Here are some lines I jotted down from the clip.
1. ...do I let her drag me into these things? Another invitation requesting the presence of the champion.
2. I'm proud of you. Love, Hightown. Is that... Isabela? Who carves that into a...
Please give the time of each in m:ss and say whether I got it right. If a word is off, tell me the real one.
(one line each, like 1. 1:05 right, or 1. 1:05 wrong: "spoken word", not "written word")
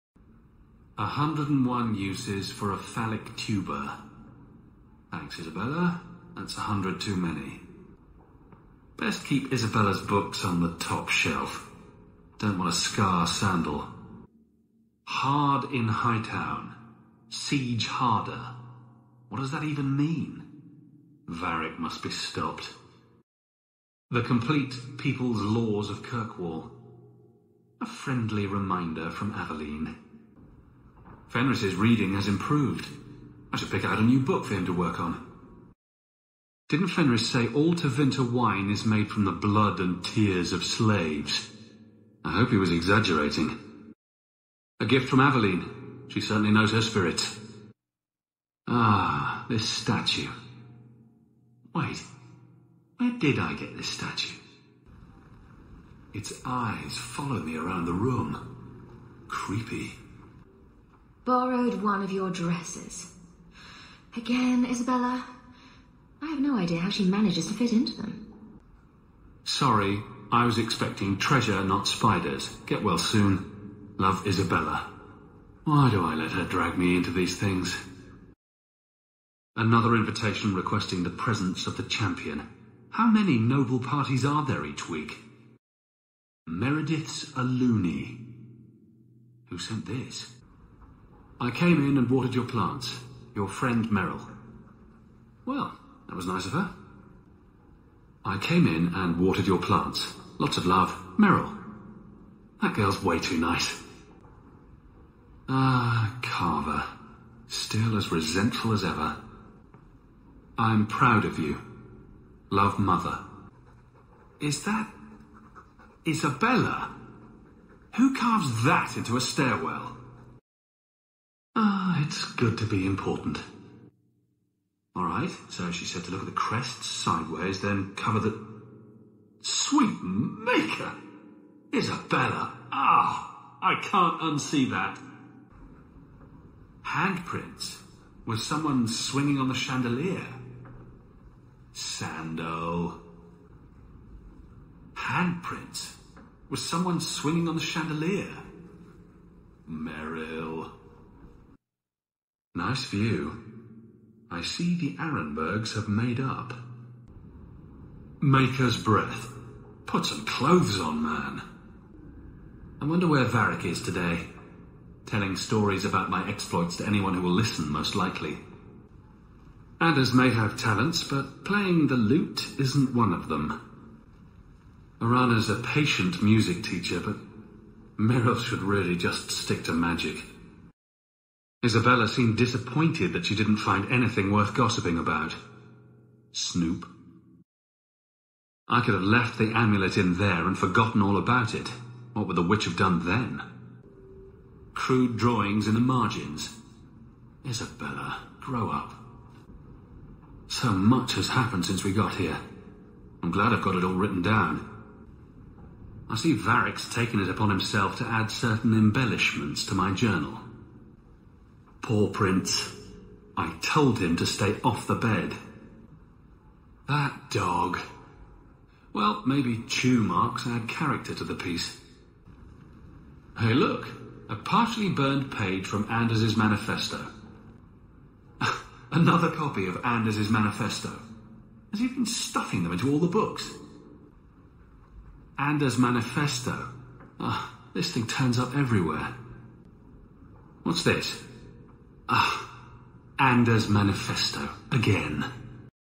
1. 1:15 right
2. 1:50 wrong: "Mother", not "Hightown".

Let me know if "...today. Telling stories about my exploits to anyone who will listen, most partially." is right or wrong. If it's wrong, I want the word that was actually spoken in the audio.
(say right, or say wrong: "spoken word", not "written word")
wrong: "likely", not "partially".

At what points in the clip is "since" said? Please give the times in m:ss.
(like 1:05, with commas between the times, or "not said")
3:21.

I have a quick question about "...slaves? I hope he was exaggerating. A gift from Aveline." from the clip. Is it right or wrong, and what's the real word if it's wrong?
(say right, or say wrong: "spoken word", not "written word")
right.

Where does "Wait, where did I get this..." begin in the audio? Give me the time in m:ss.
0:51.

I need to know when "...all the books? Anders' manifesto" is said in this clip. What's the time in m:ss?
3:52.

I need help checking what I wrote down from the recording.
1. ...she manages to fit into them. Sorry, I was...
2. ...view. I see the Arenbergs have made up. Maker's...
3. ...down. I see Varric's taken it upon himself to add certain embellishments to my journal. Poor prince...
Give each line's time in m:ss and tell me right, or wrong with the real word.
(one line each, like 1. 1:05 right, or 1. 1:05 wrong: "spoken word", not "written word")
1. 1:06 right
2. 2:32 right
3. 3:24 right.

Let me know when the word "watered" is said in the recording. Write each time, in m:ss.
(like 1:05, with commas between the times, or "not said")
1:32, 1:39.